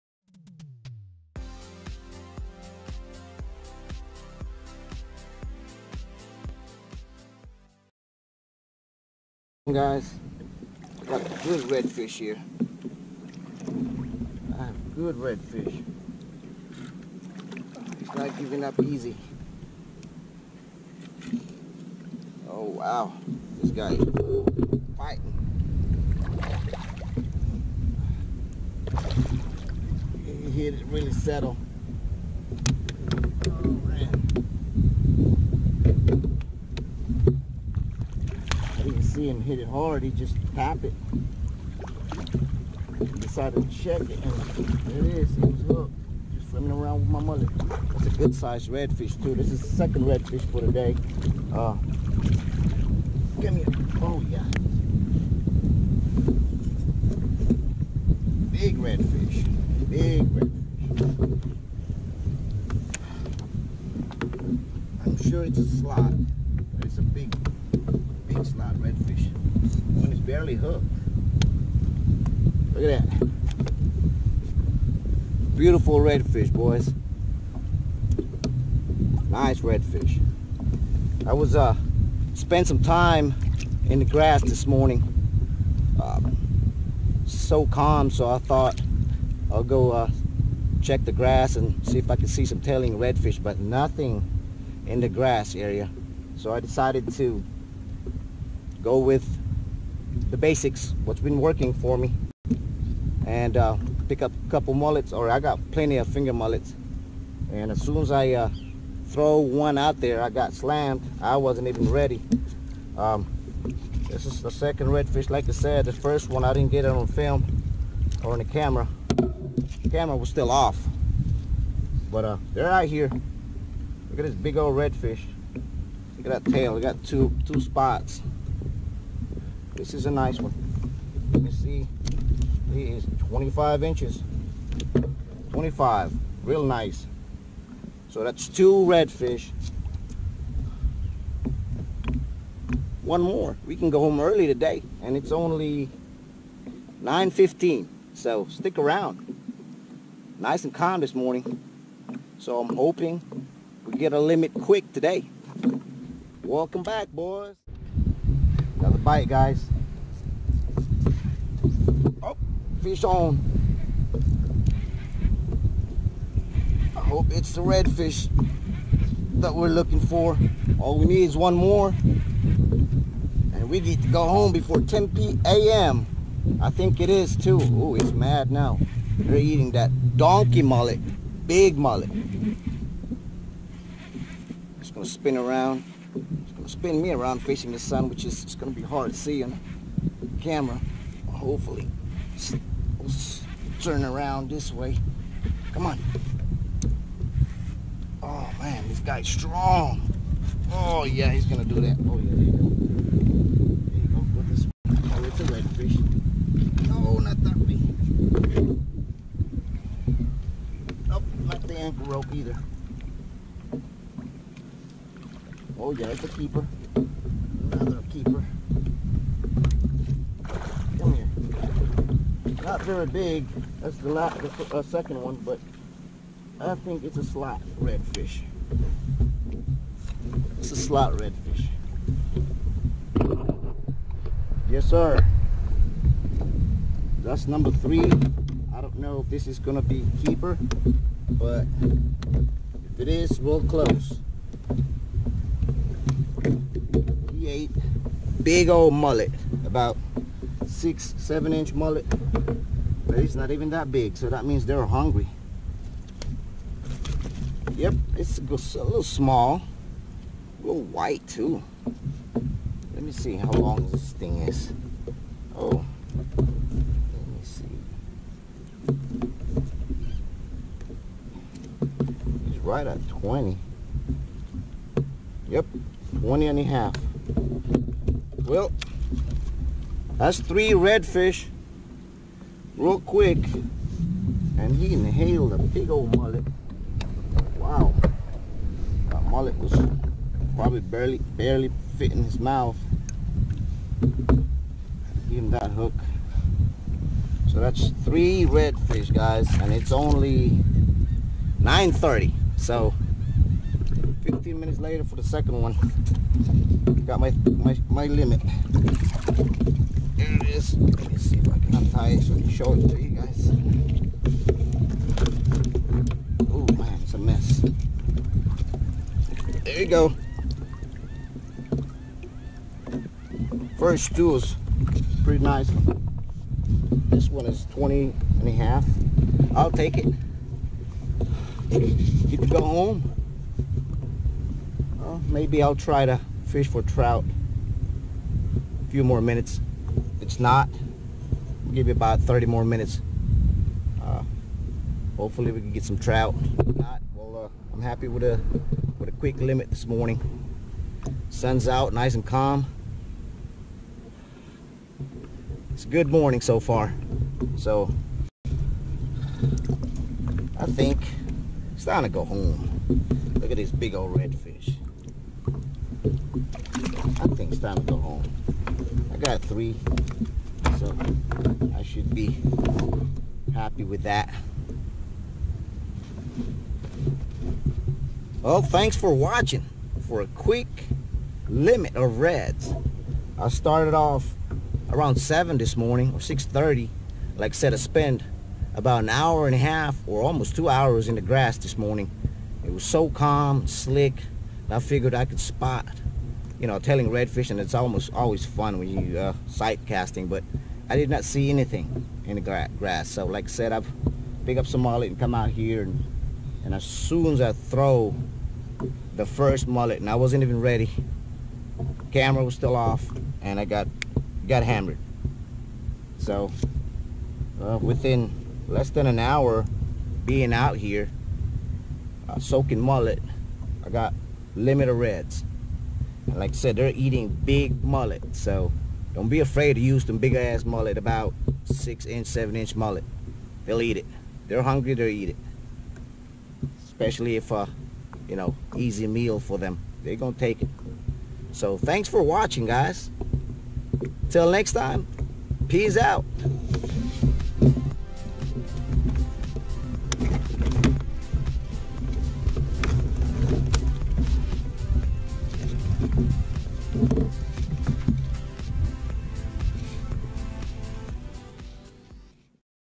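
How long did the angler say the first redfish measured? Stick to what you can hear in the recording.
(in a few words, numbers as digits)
25 inches.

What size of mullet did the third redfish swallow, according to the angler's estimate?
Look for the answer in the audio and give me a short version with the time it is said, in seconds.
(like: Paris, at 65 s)
6-7 inches, at 249 s.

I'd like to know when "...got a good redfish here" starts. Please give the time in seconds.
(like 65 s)
11 s.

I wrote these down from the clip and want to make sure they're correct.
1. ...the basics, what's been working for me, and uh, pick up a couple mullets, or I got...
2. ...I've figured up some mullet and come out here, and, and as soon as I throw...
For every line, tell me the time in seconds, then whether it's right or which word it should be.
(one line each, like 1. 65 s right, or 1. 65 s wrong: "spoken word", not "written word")
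1. 100 s right
2. 403 s wrong: "picked", not "figured".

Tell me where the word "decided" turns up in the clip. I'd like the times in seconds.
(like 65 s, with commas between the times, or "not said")
43 s, 96 s.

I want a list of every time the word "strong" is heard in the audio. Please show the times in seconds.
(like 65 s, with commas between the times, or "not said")
199 s.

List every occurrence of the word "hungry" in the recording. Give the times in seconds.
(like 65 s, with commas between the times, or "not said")
254 s, 434 s.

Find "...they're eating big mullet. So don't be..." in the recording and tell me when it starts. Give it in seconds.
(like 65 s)
426 s.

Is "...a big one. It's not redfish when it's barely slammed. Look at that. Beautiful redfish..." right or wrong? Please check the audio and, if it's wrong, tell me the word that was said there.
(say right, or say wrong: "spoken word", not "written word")
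wrong: "hooked", not "slammed".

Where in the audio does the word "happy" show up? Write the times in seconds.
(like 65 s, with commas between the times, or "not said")
347 s, 373 s.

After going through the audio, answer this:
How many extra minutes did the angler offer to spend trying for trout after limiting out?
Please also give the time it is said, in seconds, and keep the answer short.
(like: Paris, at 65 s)
30, at 342 s.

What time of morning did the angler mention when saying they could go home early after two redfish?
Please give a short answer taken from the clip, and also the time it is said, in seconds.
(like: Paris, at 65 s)
9:15, at 147 s.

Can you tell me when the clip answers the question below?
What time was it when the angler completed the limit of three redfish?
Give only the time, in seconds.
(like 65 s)
301 s.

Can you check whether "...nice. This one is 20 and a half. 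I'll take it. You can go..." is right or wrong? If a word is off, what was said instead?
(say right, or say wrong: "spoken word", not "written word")
right.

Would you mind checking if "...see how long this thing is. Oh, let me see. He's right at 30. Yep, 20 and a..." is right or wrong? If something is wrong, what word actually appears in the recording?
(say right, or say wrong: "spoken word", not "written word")
wrong: "20", not "30".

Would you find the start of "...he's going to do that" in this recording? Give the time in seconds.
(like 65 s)
201 s.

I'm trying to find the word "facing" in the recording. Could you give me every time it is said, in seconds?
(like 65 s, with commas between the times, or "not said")
187 s.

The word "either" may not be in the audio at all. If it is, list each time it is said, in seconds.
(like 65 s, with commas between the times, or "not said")
212 s.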